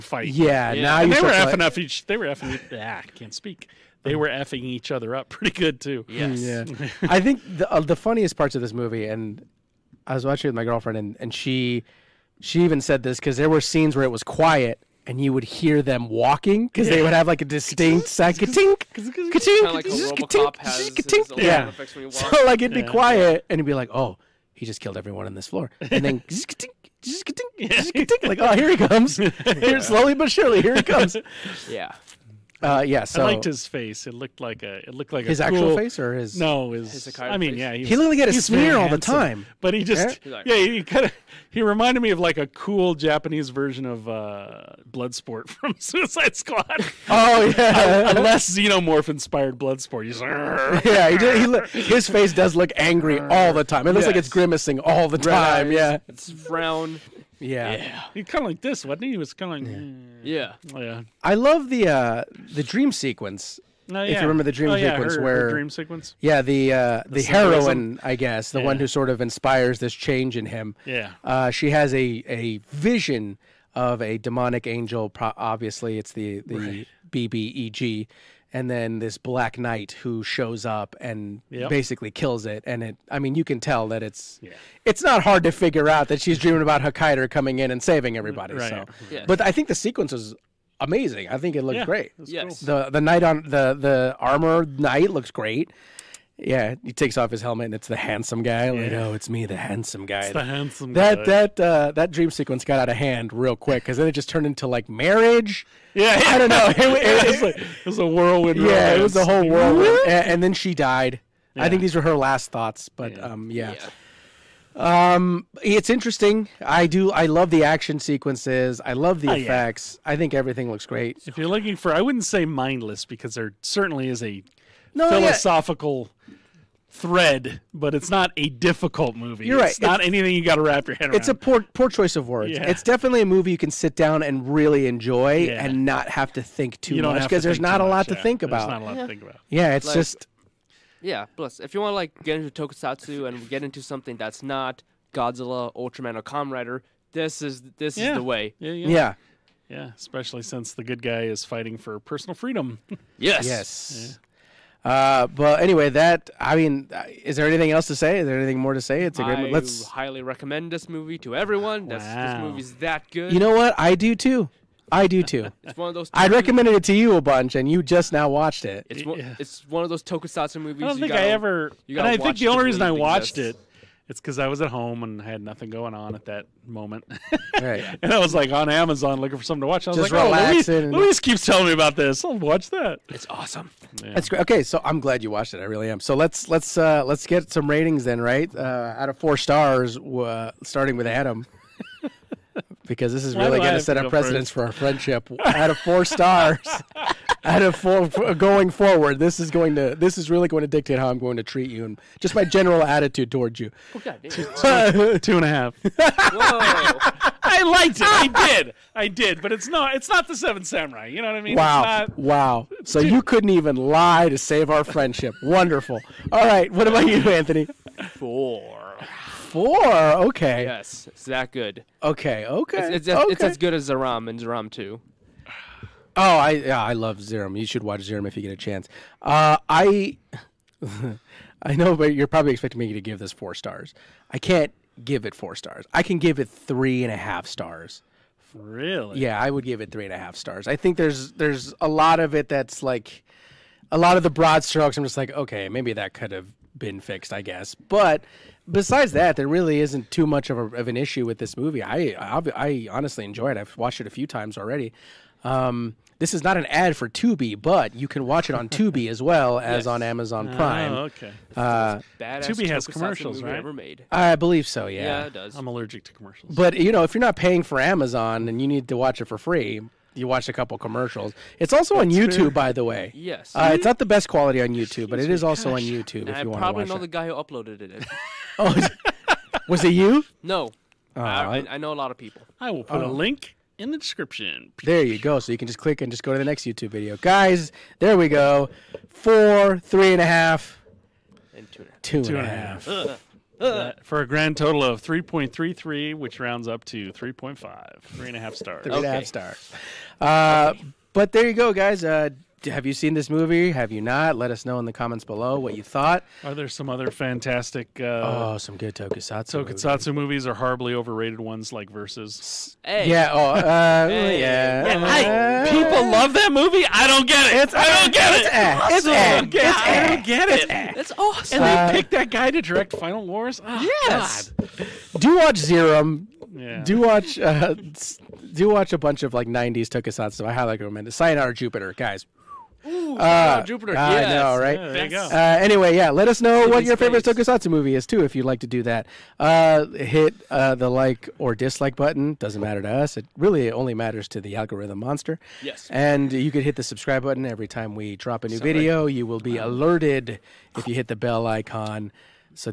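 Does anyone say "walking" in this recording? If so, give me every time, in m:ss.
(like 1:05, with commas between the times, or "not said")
0:16.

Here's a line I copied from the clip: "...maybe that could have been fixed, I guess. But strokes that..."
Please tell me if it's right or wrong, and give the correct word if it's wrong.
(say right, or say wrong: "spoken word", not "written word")
wrong: "besides", not "strokes".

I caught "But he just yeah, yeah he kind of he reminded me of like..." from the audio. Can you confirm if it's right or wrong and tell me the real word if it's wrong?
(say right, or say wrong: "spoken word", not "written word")
right.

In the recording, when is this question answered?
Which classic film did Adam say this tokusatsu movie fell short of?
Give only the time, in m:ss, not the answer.
3:30.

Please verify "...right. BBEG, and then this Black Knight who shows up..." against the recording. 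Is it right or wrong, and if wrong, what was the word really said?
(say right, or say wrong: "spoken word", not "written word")
right.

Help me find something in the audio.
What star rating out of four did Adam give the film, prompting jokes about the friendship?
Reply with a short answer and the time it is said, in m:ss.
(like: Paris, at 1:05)
2.5, at 3:25.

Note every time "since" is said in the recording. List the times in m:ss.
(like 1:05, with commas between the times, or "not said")
2:30.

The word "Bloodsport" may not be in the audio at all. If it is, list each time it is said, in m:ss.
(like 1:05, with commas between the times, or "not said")
0:44, 0:49.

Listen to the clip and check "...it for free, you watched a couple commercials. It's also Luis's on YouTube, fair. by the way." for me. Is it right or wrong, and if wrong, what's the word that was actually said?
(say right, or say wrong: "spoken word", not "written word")
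wrong: "That", not "Luis".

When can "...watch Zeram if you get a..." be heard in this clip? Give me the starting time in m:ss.
3:47.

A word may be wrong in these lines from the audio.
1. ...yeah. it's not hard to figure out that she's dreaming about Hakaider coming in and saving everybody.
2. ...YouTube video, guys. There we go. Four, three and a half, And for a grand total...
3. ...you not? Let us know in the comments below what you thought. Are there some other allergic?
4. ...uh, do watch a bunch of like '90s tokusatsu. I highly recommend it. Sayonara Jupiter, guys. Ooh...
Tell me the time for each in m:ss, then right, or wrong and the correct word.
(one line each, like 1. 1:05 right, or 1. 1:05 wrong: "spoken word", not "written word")
1. 1:24 right
2. 4:46 right
3. 5:03 wrong: "fantastic", not "allergic"
4. 5:27 right.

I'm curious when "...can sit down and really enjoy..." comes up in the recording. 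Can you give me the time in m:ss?
2:13.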